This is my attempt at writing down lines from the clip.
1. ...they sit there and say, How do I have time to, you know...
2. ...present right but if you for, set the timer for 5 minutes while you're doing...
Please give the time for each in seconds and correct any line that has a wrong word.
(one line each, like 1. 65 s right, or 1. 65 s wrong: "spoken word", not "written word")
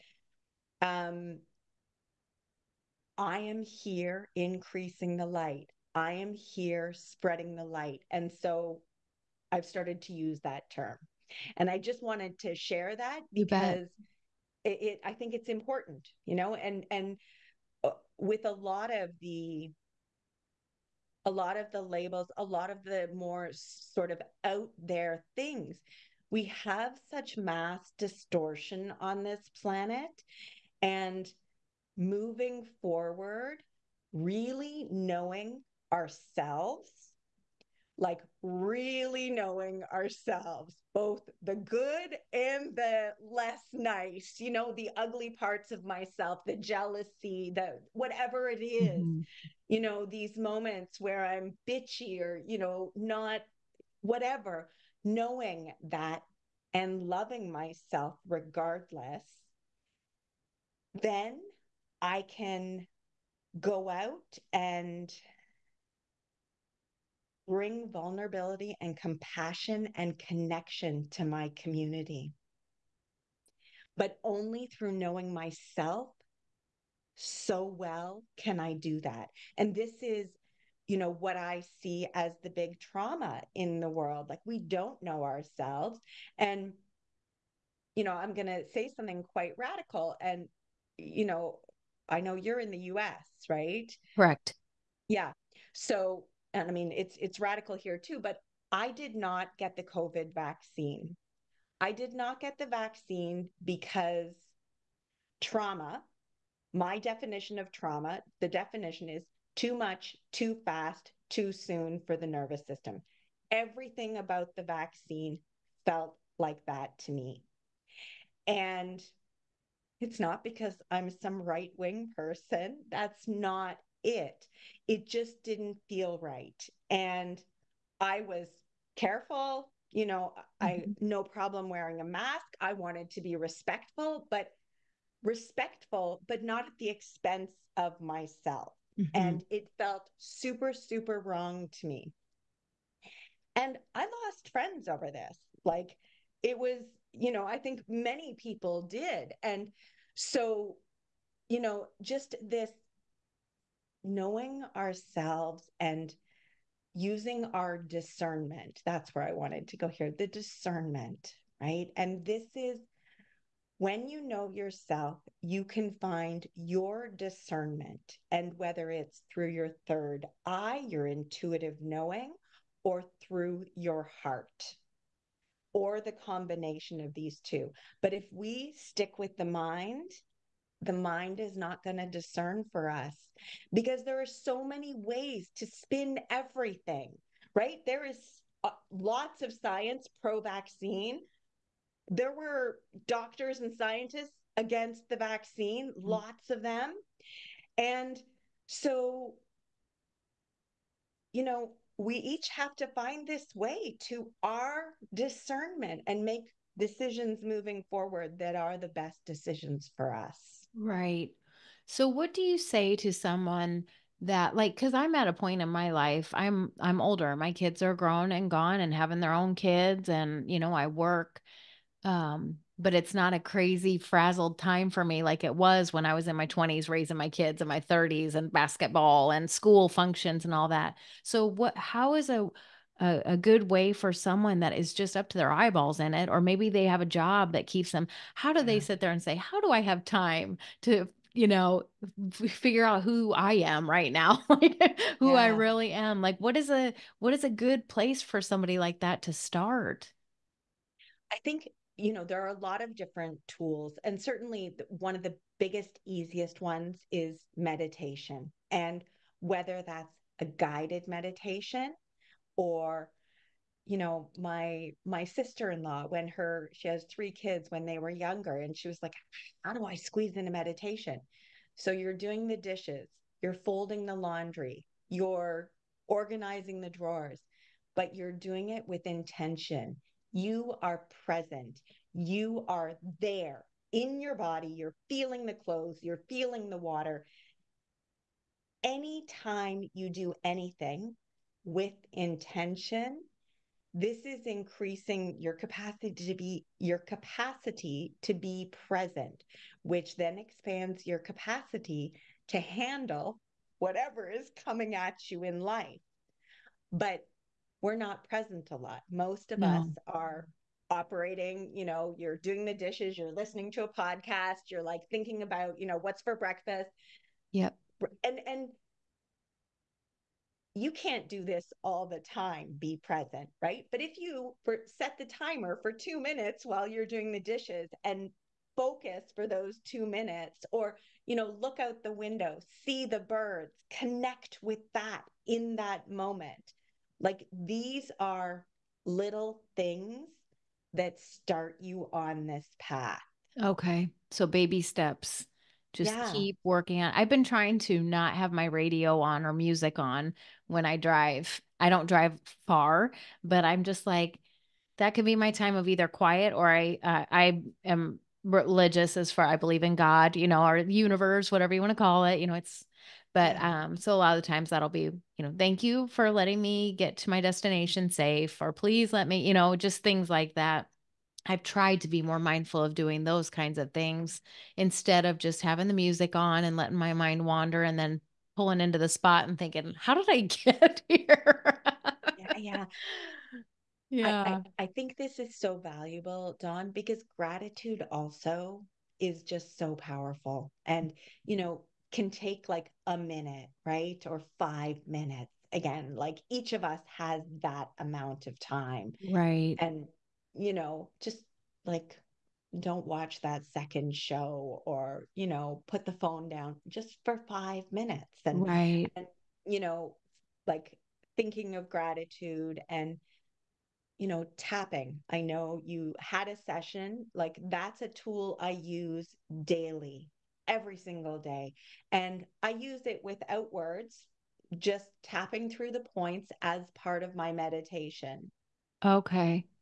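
1. 238 s right
2. 323 s wrong: "2", not "5".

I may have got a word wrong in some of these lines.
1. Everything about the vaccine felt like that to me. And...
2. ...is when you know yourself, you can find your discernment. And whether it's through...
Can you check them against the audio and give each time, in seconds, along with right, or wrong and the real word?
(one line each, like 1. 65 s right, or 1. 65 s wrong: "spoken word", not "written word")
1. 113 s right
2. 162 s right.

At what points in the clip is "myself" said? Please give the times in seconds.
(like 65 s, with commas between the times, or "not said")
45 s, 57 s, 75 s, 138 s.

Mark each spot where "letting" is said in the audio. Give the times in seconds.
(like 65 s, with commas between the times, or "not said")
366 s, 376 s.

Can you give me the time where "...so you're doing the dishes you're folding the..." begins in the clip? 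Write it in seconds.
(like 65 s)
271 s.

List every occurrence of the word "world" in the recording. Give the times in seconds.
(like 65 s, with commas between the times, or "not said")
83 s.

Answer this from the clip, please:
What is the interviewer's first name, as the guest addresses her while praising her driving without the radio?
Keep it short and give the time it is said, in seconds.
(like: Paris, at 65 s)
Dawn, at 386 s.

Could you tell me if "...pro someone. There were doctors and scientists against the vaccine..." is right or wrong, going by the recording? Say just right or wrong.
wrong.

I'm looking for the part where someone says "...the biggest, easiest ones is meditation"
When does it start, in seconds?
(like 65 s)
255 s.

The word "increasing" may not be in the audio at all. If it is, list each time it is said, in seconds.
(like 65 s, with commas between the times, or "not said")
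4 s, 294 s.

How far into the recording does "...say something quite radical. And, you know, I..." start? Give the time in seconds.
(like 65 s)
88 s.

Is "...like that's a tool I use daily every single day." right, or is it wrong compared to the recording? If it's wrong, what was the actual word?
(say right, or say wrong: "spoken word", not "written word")
right.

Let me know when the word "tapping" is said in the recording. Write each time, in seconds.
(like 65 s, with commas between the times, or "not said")
414 s, 425 s.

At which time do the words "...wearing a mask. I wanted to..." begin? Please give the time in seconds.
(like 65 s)
131 s.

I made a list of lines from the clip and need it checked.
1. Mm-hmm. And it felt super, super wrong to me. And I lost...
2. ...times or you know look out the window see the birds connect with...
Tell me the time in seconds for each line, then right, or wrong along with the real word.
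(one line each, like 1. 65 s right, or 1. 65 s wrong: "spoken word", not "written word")
1. 138 s right
2. 330 s wrong: "minutes", not "times".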